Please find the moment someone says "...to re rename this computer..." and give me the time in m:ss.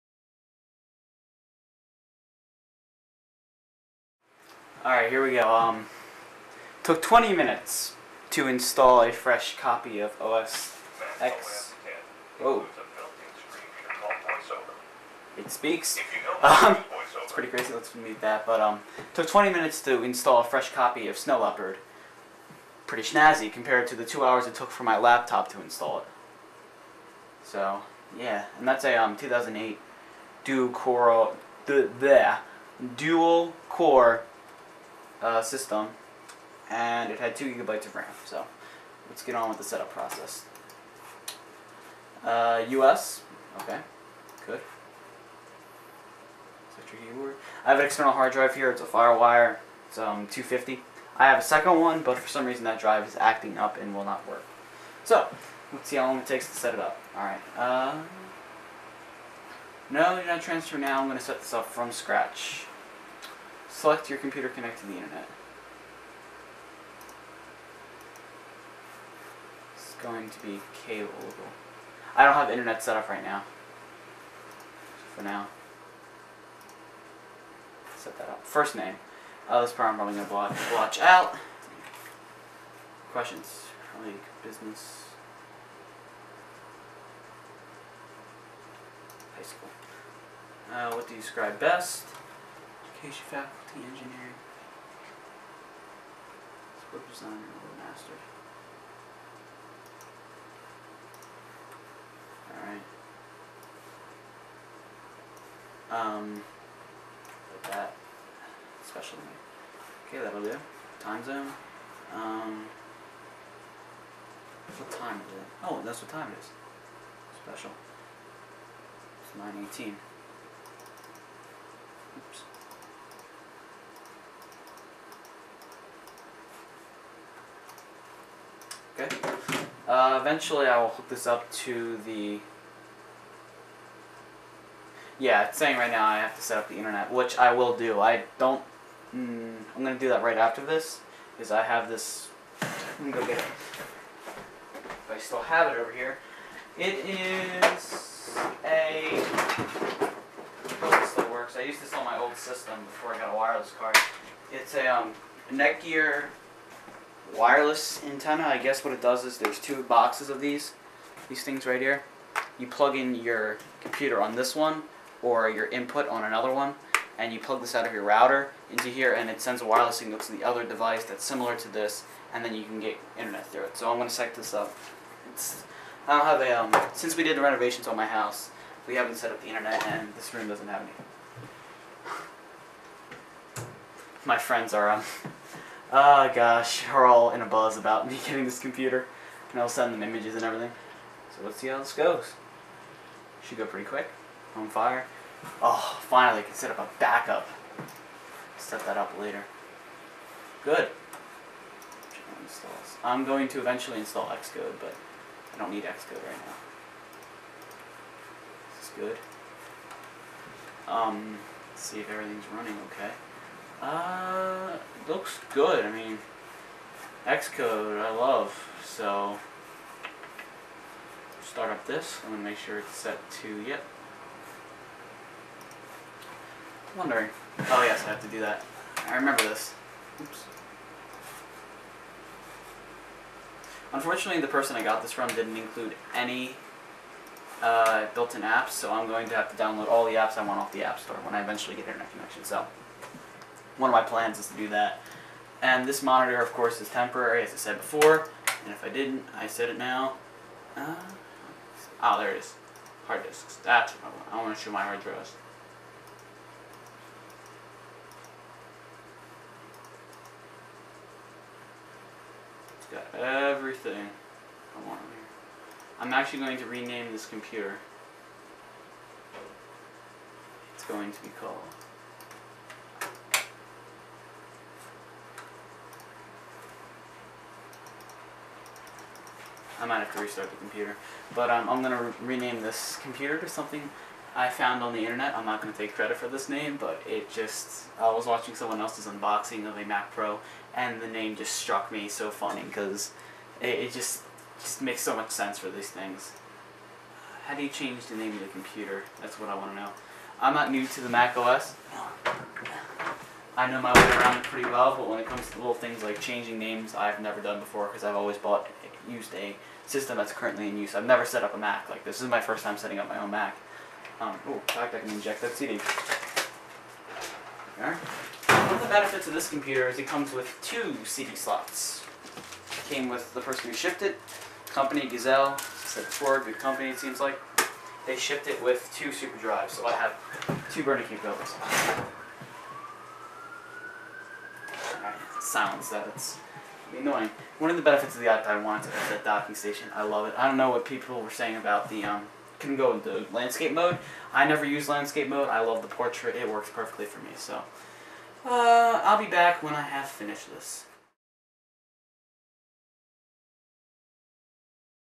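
4:41.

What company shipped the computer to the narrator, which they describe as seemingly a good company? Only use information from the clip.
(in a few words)
Gazelle.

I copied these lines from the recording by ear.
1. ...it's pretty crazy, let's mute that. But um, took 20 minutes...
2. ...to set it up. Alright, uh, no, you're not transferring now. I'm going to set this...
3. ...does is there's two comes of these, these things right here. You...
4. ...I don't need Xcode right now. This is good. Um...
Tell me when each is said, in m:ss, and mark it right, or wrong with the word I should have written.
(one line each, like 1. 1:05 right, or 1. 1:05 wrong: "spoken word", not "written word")
1. 0:17 right
2. 0:56 right
3. 2:39 wrong: "boxes", not "comes"
4. 3:25 right.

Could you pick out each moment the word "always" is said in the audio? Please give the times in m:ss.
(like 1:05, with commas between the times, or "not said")
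5:08.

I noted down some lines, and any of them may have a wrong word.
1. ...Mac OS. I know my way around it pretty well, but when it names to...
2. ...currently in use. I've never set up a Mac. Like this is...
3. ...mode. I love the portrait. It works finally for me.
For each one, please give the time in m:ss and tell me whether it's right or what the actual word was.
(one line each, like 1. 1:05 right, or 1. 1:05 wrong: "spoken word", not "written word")
1. 5:01 wrong: "comes", not "names"
2. 5:10 right
3. 5:45 wrong: "perfectly", not "finally".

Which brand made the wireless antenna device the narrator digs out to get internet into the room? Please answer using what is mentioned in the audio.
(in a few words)
Netgear.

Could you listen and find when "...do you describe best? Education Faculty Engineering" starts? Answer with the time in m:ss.
1:31.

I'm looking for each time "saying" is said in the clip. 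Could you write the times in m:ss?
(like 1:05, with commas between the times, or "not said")
2:15, 5:41.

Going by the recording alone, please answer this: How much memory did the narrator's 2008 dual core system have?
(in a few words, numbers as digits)
2 gigabytes.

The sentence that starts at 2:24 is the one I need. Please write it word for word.
If I still have it over here.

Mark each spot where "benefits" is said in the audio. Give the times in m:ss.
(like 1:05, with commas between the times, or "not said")
5:18, 5:37.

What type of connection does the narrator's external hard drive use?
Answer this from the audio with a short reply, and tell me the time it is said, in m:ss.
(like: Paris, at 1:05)
FireWire, at 0:48.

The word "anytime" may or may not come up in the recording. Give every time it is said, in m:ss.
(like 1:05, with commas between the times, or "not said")
not said.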